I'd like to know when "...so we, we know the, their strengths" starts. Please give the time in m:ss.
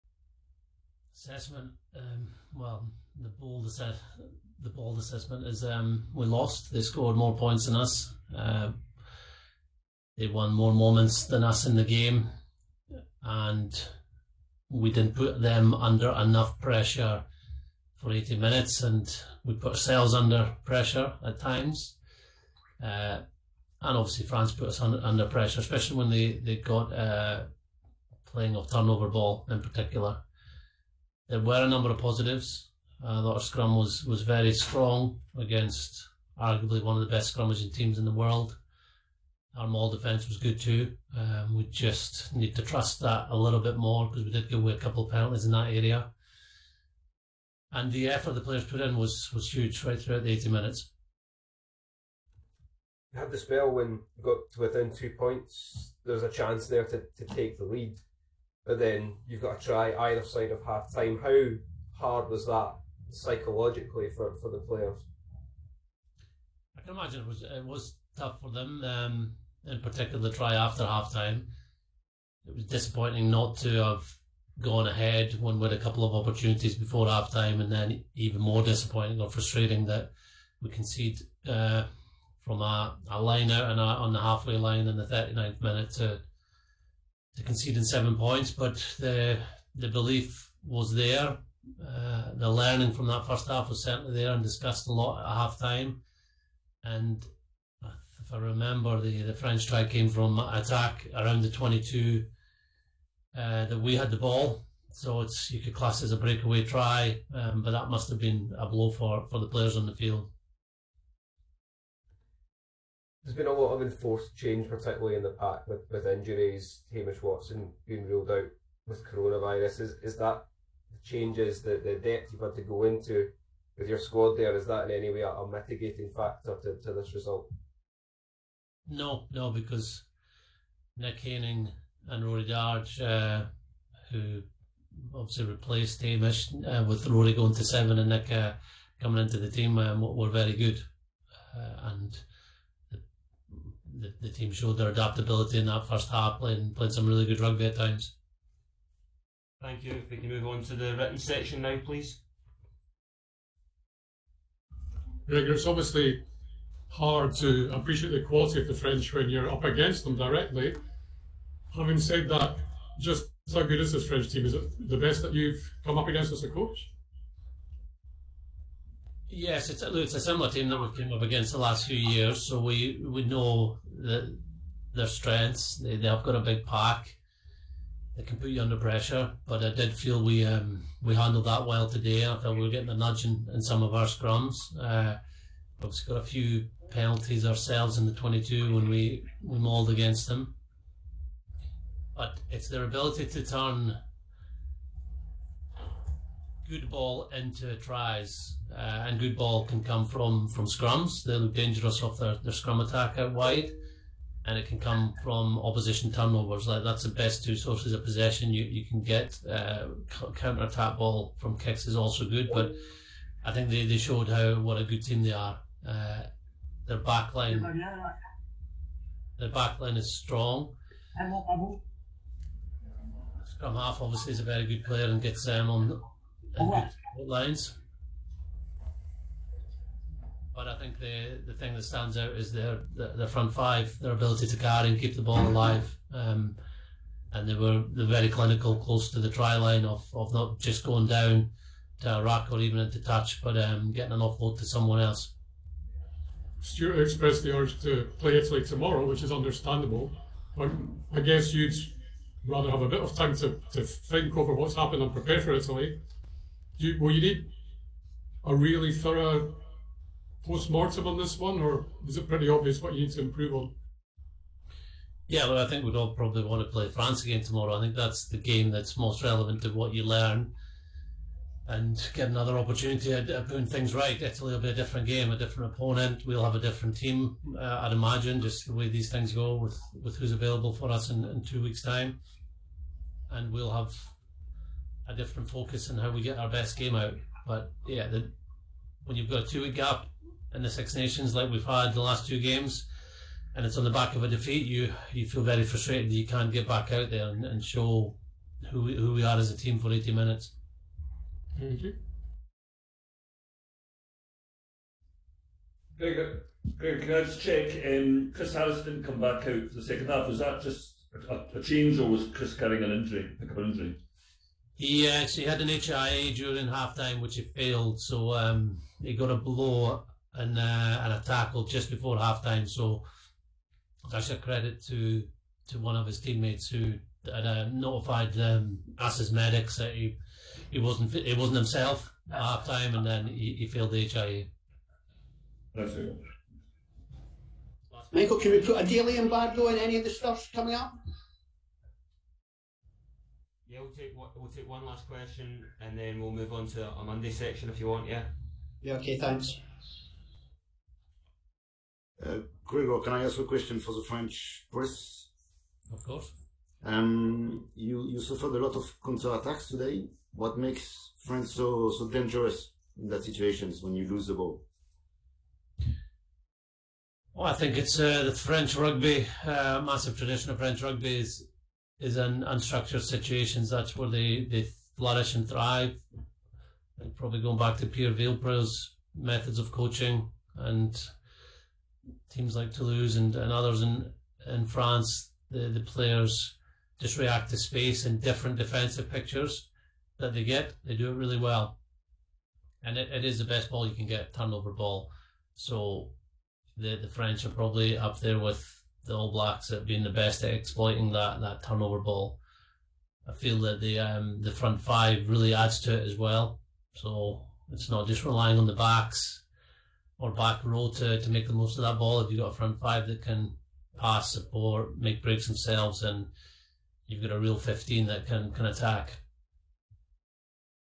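2:52.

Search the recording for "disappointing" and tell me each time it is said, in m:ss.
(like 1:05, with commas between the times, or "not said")
1:12, 1:18.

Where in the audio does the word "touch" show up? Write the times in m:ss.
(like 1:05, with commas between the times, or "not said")
4:02.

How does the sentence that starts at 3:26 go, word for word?
Like that's the best two sources of possession you, you can get.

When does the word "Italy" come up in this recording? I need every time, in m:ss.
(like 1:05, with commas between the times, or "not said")
4:08, 4:15, 4:34.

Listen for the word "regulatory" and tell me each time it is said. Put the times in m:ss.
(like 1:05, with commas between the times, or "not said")
not said.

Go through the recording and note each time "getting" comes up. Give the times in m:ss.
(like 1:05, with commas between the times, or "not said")
3:02, 4:03.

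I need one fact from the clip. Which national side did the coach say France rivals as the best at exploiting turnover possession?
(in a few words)
All Blacks.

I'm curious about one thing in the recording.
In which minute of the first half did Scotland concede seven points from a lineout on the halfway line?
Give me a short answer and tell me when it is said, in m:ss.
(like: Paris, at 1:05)
39th, at 1:25.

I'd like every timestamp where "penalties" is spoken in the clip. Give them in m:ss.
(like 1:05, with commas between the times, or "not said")
0:45, 3:06.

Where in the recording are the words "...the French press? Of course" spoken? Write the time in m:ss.
5:53.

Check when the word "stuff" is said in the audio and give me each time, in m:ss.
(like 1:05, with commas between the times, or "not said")
5:40.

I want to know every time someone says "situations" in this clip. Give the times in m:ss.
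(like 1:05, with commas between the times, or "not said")
6:03, 6:13.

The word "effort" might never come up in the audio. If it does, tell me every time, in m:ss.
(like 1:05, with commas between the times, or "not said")
0:48.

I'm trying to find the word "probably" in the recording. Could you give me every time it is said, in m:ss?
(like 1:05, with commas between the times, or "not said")
4:26, 6:17, 6:37.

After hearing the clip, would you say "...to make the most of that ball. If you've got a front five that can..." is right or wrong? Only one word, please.
right.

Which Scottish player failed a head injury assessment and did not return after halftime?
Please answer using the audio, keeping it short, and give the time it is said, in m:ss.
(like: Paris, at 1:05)
Chris Harris, at 5:08.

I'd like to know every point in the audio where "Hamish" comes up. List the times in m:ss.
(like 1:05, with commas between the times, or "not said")
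1:56, 2:16.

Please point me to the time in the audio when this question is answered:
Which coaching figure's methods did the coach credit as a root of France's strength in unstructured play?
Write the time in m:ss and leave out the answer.
6:17.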